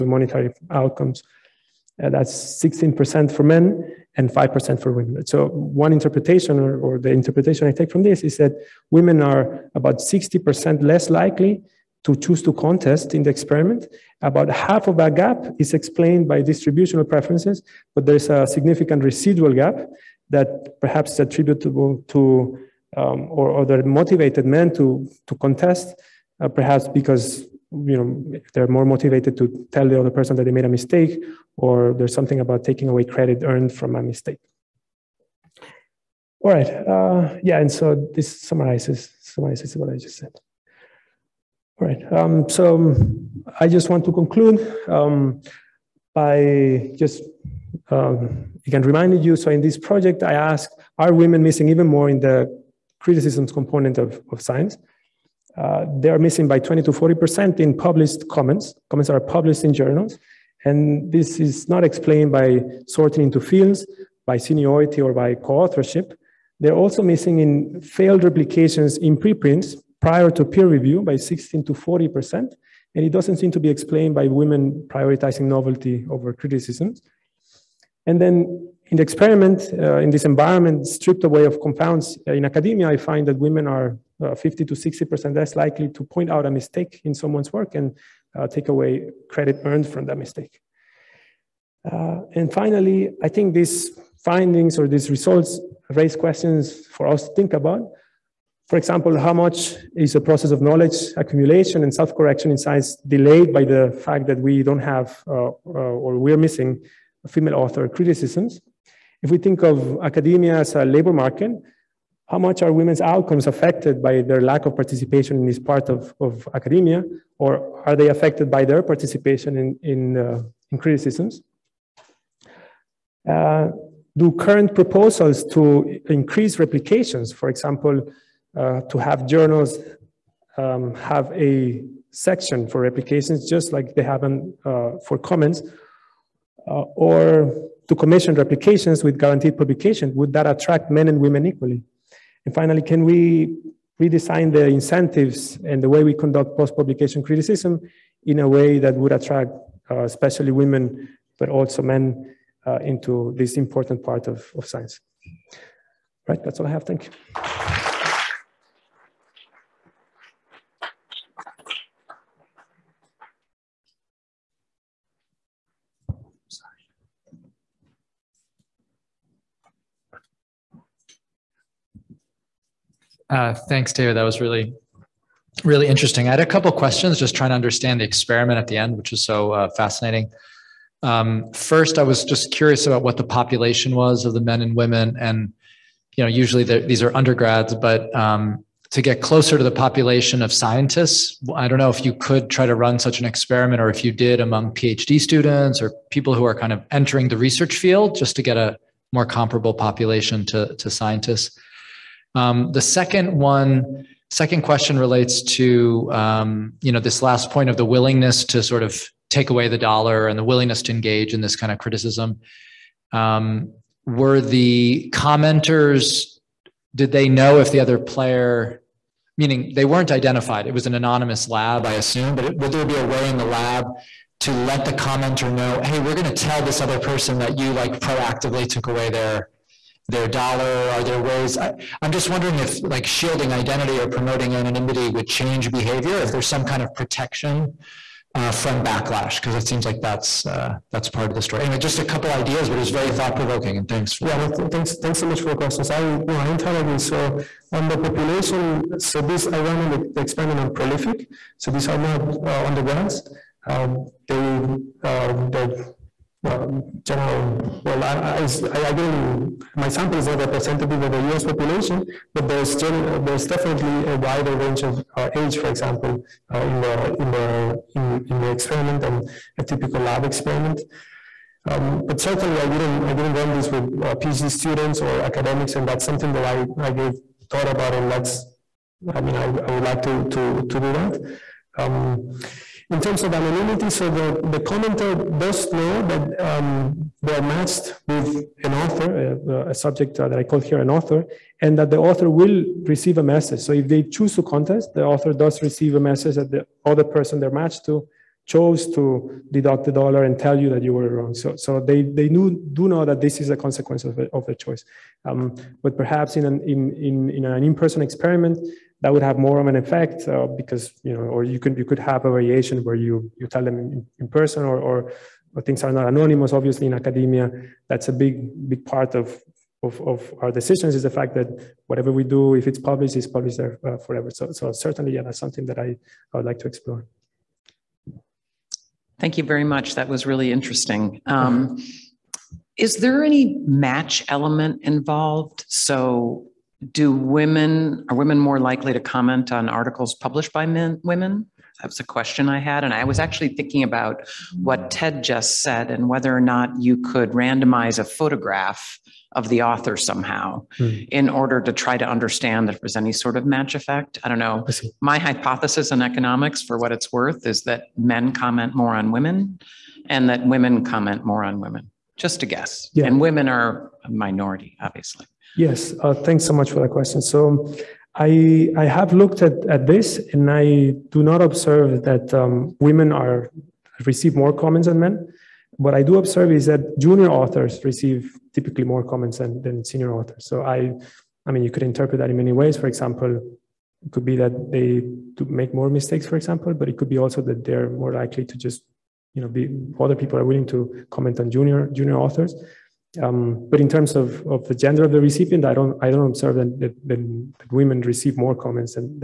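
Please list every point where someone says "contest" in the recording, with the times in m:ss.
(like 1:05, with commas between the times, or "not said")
0:12, 0:25, 4:54.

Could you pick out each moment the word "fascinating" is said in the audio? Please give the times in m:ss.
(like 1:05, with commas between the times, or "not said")
2:59.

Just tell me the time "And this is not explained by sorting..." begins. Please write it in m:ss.
1:00.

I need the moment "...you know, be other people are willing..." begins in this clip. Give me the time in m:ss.
6:29.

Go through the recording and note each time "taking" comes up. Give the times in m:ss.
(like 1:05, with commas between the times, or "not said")
0:32.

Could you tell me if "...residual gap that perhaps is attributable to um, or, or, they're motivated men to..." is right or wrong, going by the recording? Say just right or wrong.
right.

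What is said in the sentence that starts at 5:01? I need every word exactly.
So, so they, they knew, do know that this is a consequence of, of their choice.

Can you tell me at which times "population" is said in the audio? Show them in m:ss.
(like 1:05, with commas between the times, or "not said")
3:03, 3:09, 3:19, 4:07, 4:21.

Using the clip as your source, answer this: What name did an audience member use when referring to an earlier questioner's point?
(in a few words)
Ted.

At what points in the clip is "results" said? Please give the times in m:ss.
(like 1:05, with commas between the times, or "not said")
1:35.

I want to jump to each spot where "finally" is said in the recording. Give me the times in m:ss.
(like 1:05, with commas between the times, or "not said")
1:32, 2:22.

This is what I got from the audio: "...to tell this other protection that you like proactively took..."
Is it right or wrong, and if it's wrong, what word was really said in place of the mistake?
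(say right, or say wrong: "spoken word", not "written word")
wrong: "person", not "protection".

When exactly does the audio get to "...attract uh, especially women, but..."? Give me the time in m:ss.
2:29.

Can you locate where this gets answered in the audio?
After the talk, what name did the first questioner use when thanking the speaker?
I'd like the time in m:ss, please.
2:53.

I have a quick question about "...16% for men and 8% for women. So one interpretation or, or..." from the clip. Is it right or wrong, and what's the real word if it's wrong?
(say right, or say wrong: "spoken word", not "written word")
wrong: "5", not "8".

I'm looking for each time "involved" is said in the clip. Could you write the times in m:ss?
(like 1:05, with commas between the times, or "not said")
5:34.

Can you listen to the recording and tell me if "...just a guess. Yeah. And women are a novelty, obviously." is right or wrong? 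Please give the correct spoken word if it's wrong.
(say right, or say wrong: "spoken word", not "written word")
wrong: "minority", not "novelty".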